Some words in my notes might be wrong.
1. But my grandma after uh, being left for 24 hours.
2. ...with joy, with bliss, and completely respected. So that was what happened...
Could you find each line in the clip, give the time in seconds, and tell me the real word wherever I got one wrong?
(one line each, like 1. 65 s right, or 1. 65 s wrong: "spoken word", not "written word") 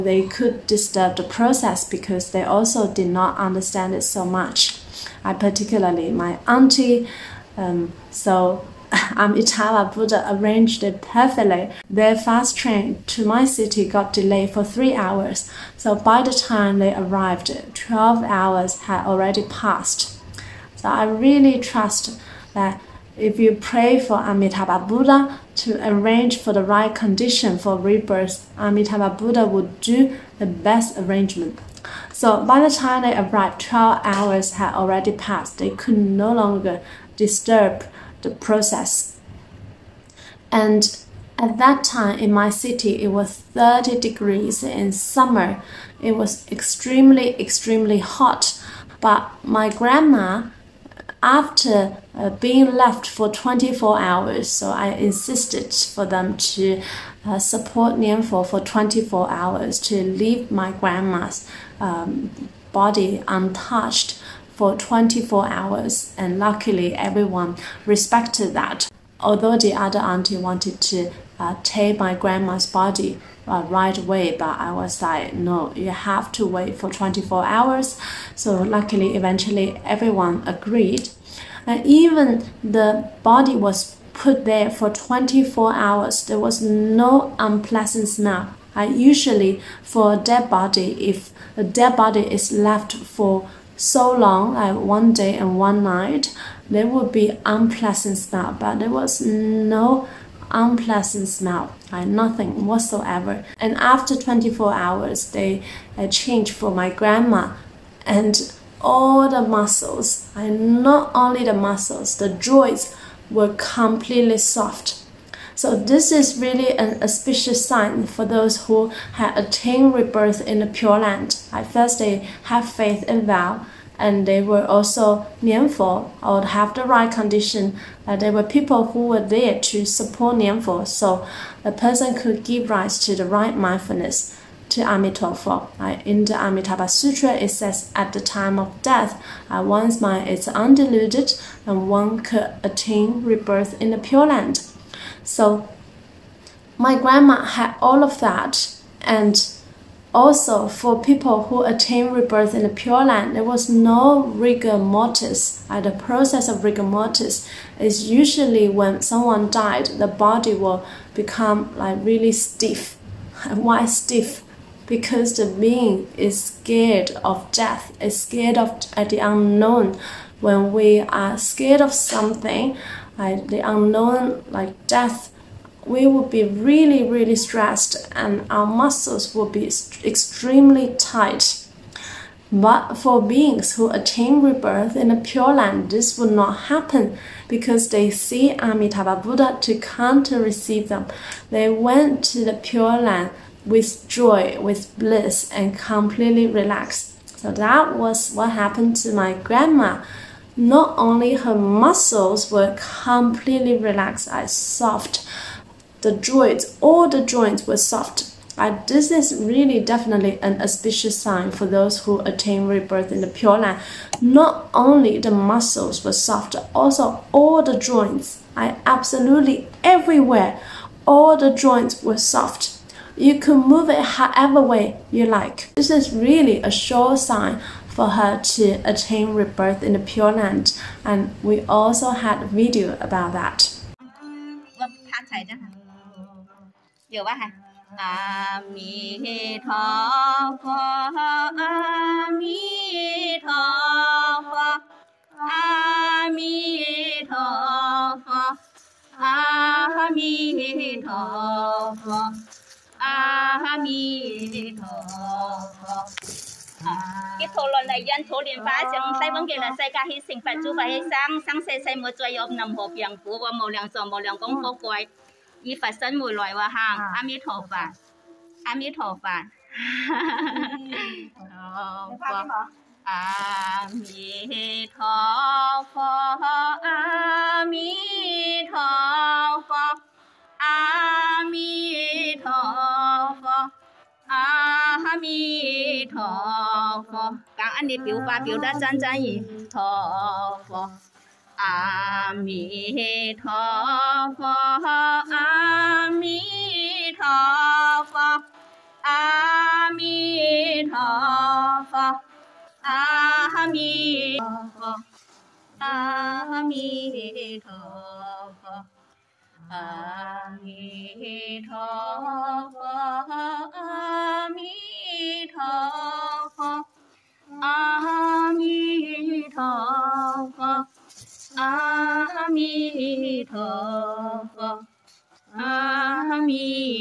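1. 49 s right
2. 193 s wrong: "relaxed", not "respected".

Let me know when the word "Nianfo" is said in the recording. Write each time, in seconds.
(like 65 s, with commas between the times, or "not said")
57 s, 125 s, 130 s.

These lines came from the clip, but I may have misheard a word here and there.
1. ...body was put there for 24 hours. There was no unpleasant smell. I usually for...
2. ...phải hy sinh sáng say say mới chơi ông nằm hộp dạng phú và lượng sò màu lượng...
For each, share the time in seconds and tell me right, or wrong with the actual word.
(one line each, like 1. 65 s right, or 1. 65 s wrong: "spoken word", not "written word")
1. 83 s right
2. 260 s right.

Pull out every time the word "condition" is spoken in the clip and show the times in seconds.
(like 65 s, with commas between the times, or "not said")
26 s, 127 s.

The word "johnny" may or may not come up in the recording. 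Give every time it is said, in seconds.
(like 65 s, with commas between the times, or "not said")
not said.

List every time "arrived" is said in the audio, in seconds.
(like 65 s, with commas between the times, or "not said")
16 s, 33 s.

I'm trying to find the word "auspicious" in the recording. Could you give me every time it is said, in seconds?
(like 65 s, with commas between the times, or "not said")
117 s, 210 s.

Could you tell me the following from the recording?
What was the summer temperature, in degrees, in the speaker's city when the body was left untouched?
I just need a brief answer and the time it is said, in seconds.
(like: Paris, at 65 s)
30, at 43 s.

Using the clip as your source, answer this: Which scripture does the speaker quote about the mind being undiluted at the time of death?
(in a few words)
Amitabha Sutra.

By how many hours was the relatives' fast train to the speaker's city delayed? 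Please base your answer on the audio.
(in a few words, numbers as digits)
3.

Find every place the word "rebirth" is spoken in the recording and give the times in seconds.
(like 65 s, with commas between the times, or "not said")
27 s, 119 s, 143 s, 152 s, 184 s, 212 s, 229 s.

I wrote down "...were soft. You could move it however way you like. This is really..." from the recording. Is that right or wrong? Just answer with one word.
right.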